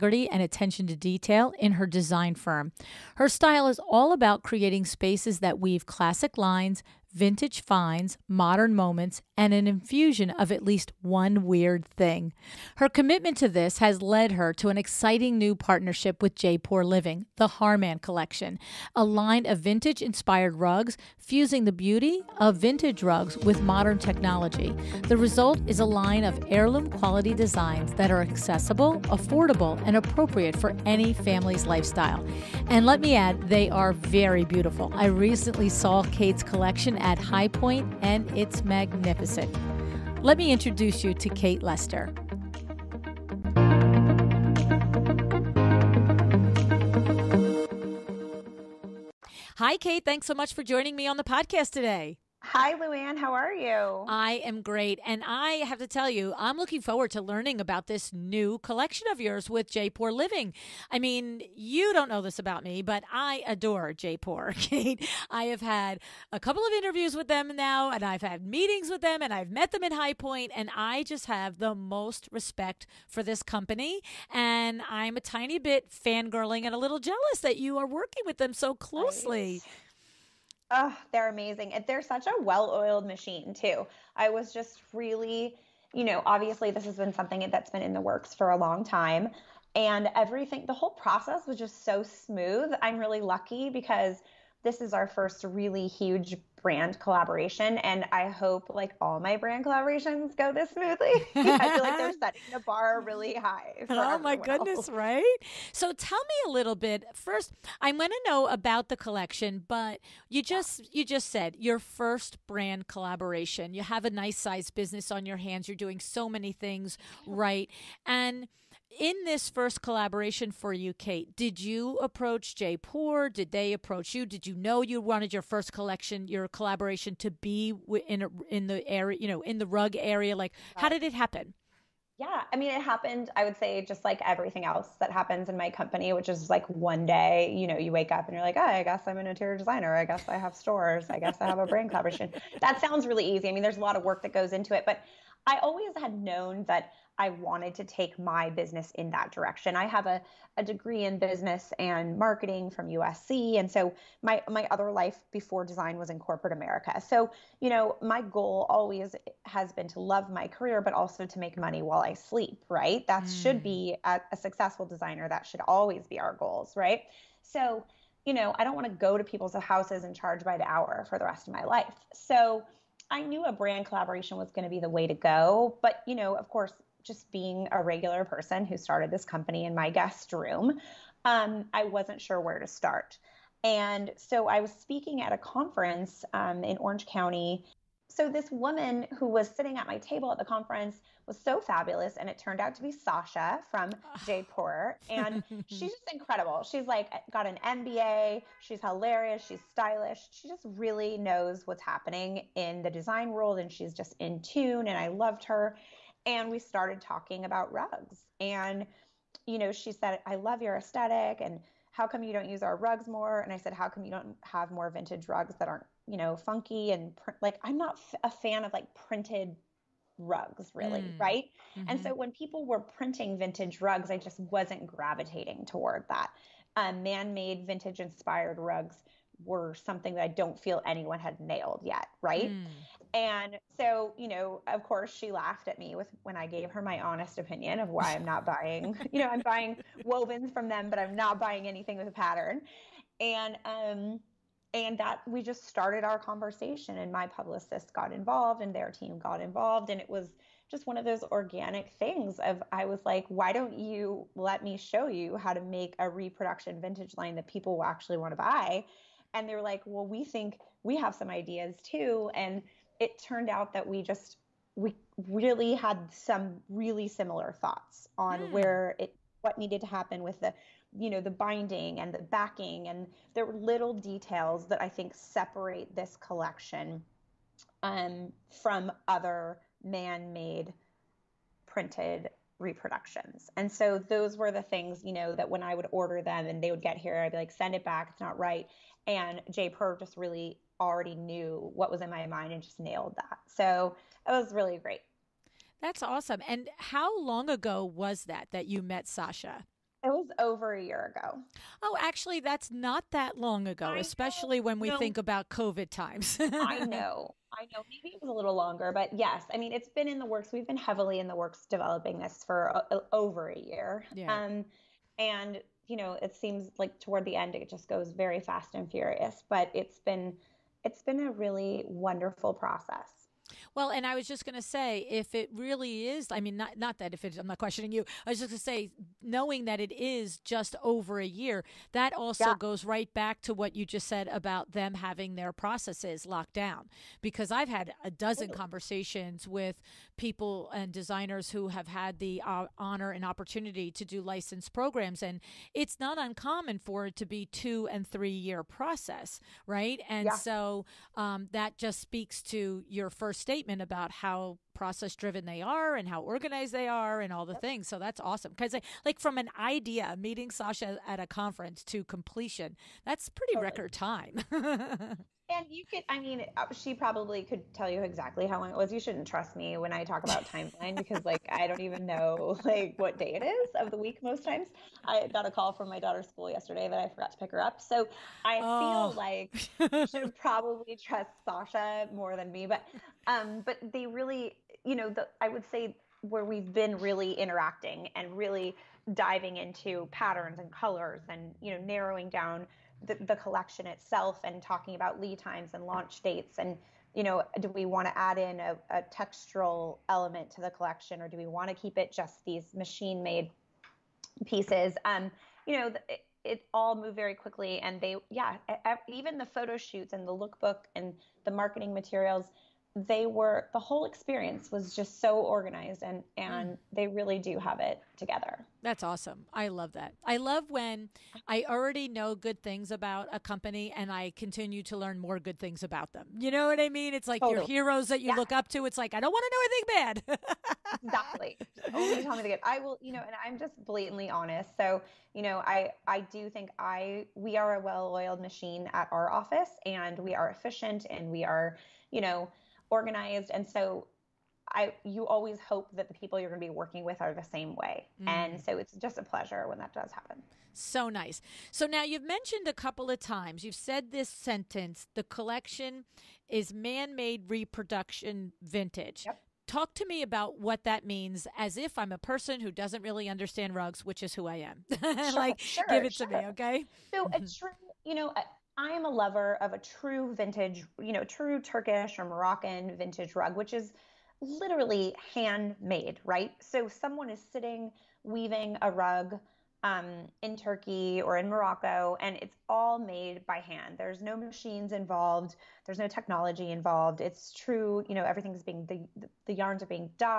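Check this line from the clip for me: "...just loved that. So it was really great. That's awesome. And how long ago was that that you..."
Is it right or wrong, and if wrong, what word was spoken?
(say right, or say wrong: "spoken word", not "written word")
wrong: "nailed", not "loved".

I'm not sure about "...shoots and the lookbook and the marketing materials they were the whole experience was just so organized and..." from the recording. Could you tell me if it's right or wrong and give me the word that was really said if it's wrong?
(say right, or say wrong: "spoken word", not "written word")
right.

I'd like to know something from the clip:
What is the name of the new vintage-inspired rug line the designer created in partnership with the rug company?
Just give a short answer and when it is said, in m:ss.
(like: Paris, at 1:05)
Harman Collection, at 0:17.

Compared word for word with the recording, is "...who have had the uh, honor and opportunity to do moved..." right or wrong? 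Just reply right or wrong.
wrong.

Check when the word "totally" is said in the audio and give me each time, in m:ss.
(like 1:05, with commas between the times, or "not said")
6:03, 7:07.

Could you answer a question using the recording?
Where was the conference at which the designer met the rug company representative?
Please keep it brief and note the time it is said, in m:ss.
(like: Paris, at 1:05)
Orange County, at 3:06.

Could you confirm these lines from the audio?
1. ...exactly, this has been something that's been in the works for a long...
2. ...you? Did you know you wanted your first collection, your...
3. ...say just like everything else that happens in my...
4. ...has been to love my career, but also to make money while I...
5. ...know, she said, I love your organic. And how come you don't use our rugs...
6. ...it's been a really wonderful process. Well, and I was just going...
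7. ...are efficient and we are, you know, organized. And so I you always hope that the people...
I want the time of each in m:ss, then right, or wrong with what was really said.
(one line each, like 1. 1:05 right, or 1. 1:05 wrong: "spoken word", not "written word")
1. 1:26 wrong: "obviously", not "exactly"
2. 2:04 right
3. 2:13 right
4. 2:39 right
5. 3:29 wrong: "aesthetic", not "organic"
6. 5:20 right
7. 7:20 right.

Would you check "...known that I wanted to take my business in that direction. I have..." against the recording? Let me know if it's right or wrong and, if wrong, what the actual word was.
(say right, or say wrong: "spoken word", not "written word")
right.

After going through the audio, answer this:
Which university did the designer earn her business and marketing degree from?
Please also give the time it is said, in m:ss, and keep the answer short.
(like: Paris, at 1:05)
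USC, at 2:32.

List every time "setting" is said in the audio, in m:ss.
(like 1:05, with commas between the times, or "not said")
1:42.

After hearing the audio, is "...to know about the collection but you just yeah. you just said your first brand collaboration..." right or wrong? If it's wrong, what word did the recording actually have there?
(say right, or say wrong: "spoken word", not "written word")
right.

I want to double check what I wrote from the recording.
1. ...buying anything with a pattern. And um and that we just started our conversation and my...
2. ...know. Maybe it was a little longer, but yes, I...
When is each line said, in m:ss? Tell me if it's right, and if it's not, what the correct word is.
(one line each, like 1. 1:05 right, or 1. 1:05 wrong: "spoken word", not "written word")
1. 4:01 right
2. 5:07 right.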